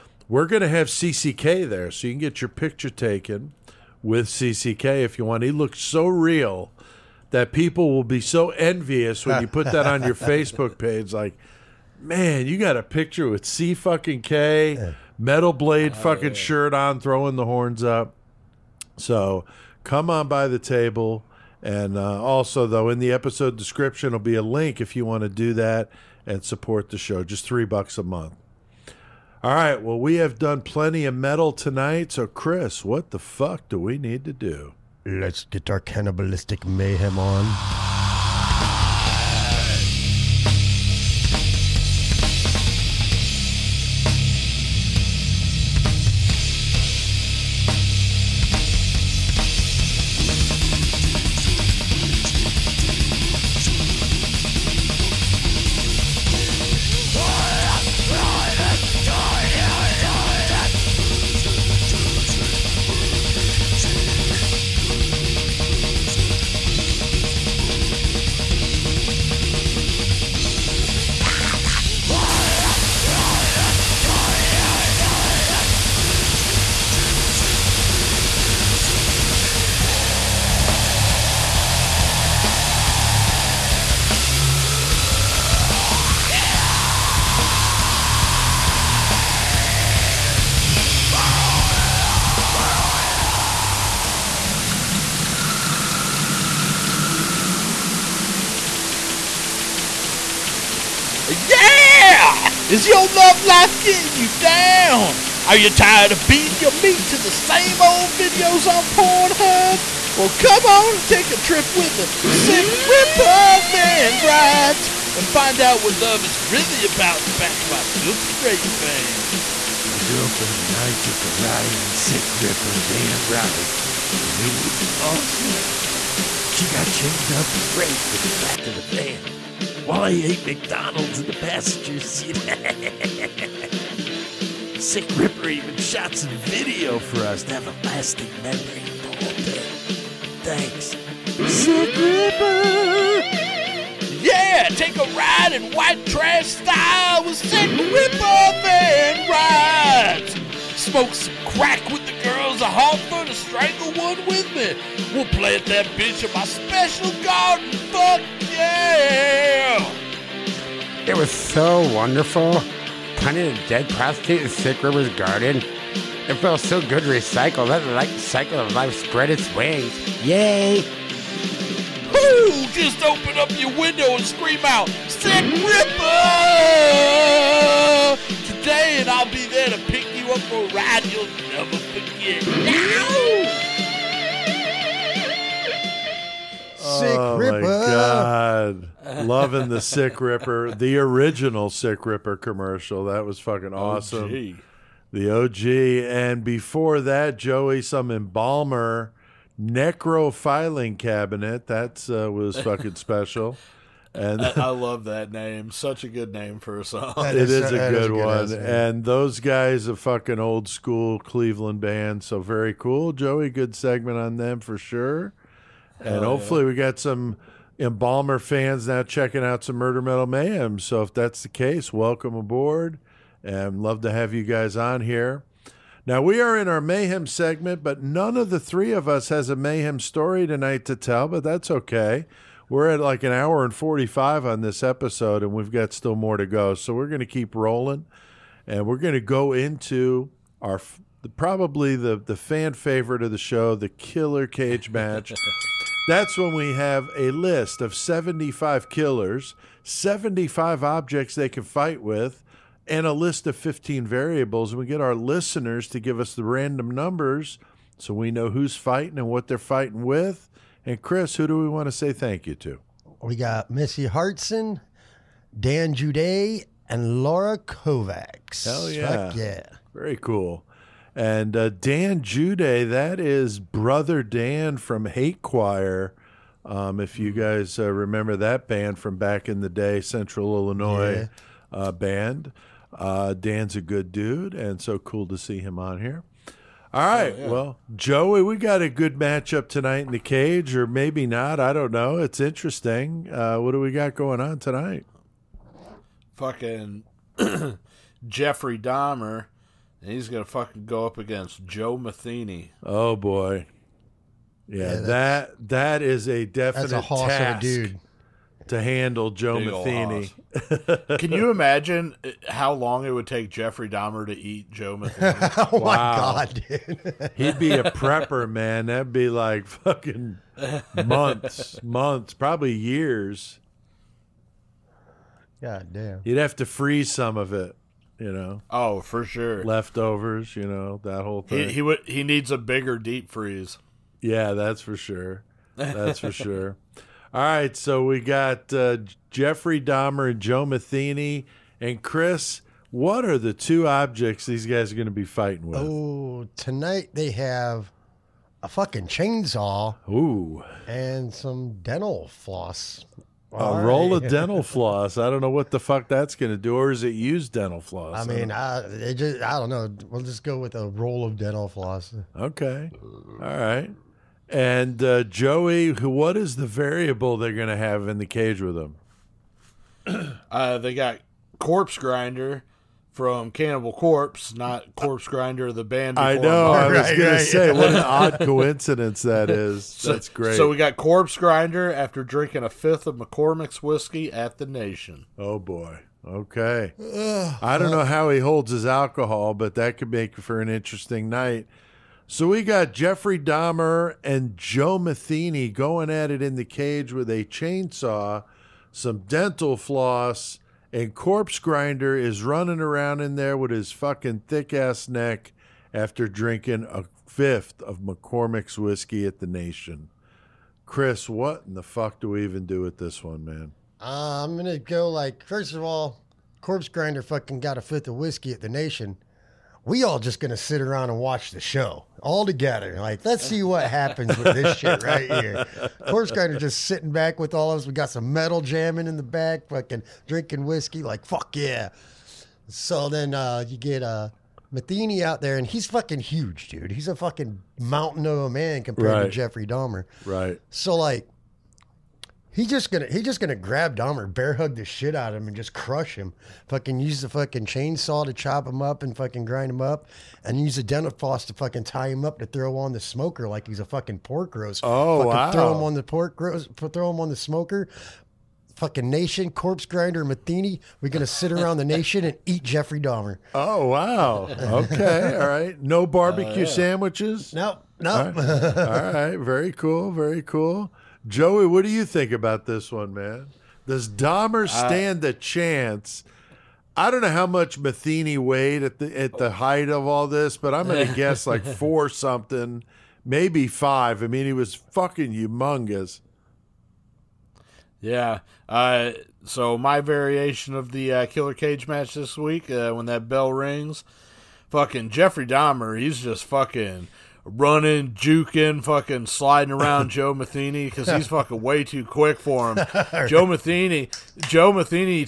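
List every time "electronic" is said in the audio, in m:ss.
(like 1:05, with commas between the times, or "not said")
not said.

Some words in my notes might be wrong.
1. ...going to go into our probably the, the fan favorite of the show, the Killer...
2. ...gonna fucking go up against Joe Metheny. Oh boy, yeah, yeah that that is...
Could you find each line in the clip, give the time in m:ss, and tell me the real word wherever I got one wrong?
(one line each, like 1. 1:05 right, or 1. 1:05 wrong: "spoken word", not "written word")
1. 3:58 right
2. 5:00 right.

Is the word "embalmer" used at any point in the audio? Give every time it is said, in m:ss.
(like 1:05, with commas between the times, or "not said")
3:18, 3:37.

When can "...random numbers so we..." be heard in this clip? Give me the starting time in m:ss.
4:16.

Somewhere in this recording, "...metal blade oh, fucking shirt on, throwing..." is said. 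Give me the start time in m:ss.
0:15.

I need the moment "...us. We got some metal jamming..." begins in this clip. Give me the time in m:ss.
7:07.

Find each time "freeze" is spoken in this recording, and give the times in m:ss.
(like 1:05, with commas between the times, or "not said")
5:26, 5:33.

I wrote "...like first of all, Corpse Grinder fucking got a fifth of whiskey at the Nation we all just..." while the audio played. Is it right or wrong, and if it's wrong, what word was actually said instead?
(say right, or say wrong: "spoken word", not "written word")
right.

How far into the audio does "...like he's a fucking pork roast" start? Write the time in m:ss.
7:33.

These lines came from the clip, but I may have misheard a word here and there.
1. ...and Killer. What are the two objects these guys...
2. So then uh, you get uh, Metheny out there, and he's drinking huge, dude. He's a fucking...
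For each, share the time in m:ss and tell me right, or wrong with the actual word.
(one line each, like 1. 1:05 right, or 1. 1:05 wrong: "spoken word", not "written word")
1. 5:41 wrong: "Chris", not "Killer"
2. 7:12 wrong: "fucking", not "drinking".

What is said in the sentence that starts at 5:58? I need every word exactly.
I mean, I, I, just, I don't know.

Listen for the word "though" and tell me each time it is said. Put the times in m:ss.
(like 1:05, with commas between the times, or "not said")
0:22.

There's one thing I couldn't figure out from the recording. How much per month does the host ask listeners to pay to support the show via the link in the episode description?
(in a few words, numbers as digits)
3 bucks.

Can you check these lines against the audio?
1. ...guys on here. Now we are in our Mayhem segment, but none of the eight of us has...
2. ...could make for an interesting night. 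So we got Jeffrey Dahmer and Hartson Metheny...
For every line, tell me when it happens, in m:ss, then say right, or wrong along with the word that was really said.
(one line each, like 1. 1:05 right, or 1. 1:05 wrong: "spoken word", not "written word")
1. 3:44 wrong: "three", not "eight"
2. 6:29 wrong: "Joe", not "Hartson".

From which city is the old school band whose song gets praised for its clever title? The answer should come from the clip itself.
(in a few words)
Cleveland.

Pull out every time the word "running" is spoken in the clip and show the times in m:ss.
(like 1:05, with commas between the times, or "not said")
6:42, 8:17.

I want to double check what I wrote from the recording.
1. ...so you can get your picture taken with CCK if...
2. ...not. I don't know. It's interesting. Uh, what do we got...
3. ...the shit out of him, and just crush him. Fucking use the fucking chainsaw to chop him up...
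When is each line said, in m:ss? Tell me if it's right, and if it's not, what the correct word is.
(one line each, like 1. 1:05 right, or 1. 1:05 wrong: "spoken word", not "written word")
1. 0:01 right
2. 4:51 right
3. 7:24 right.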